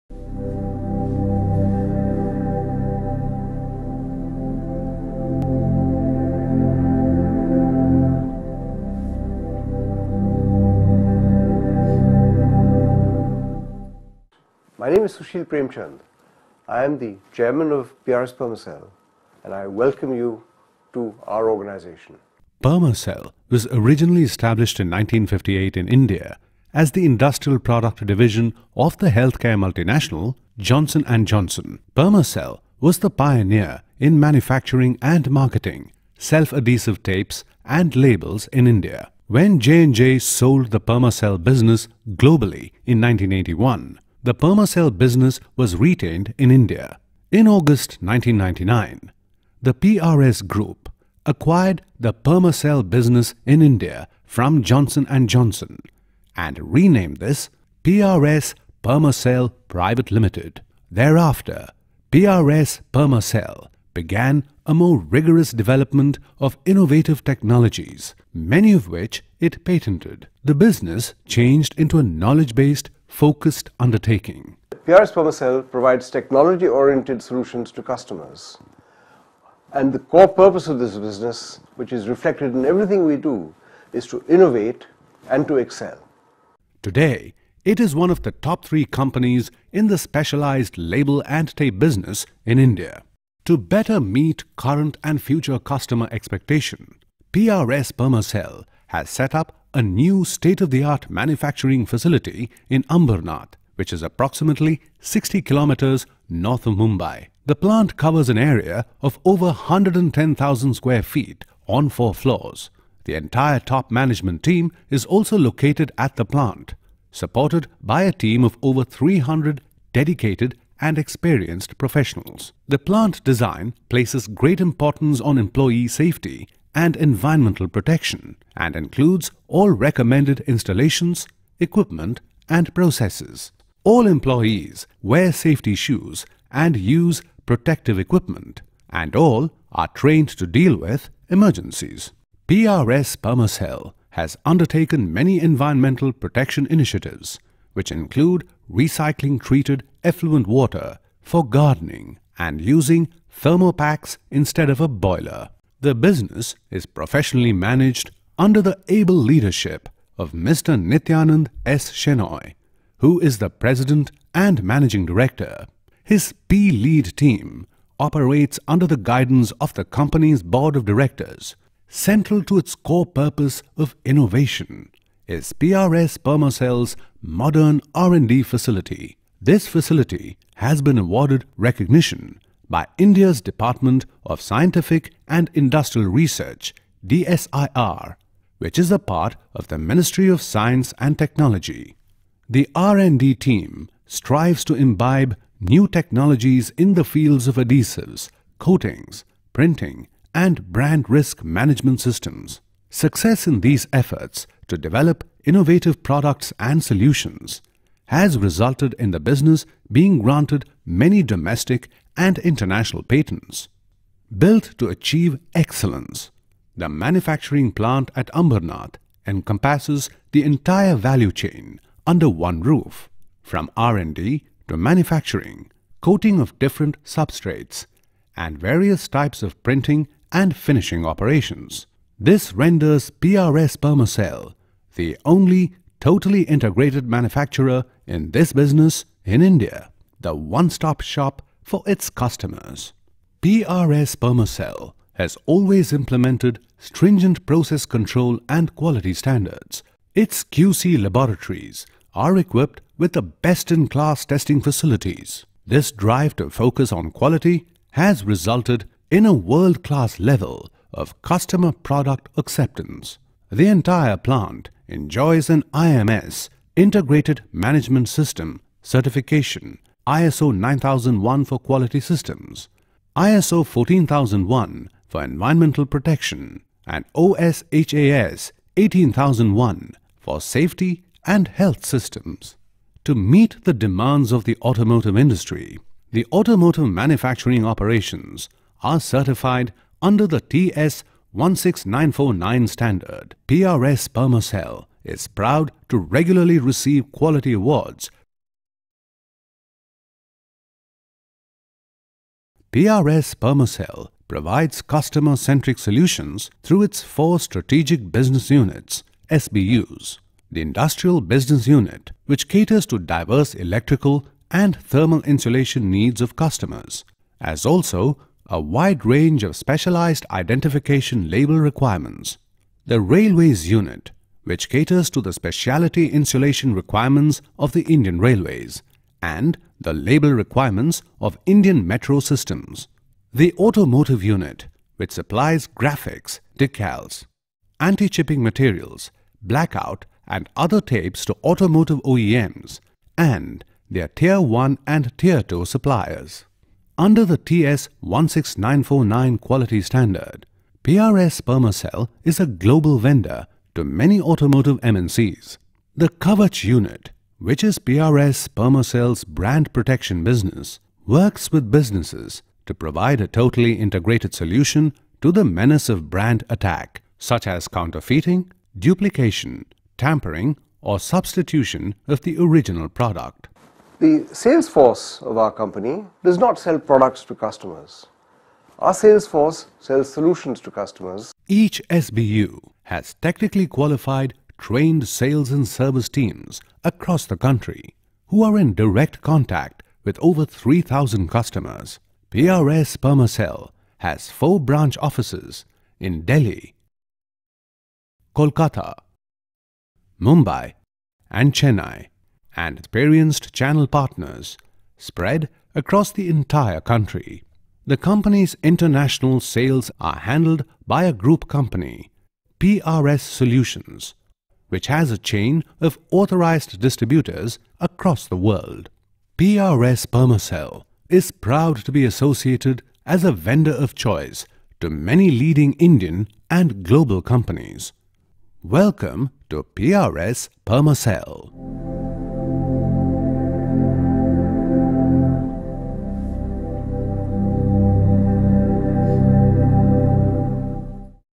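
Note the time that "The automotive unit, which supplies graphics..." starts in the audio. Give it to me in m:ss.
5:33.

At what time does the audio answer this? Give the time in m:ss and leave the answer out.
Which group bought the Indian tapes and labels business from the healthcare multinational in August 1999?
0:49.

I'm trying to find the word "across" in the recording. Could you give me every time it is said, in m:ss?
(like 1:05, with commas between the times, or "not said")
6:26, 6:45, 6:57.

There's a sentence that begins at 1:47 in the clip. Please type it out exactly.
The plant covers an area of over 110,000 square feet on four floors.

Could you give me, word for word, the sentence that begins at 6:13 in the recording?
The sales force of our company does not sell products to customers.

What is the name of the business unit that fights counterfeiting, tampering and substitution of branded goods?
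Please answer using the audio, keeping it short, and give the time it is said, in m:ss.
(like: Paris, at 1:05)
Kavach, at 5:56.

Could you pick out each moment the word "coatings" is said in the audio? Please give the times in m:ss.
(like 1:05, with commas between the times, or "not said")
3:18, 3:45.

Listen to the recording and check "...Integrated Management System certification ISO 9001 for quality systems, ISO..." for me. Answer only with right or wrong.
right.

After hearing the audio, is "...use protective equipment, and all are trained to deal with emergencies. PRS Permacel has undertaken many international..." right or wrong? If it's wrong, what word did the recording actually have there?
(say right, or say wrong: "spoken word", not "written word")
wrong: "environmental", not "international".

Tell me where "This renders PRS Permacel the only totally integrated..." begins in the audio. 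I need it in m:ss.
3:52.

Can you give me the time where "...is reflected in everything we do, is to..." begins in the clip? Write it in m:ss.
1:21.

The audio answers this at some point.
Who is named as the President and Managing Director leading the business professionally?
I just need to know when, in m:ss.
2:40.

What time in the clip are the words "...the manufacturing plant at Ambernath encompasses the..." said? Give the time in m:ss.
3:36.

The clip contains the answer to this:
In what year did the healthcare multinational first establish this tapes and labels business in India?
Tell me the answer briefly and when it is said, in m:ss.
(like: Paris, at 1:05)
1958, at 0:24.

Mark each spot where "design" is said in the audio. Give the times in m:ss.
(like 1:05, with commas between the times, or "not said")
2:03.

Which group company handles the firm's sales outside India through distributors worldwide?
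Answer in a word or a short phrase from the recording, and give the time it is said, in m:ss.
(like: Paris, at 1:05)
PRS Solutions, at 6:52.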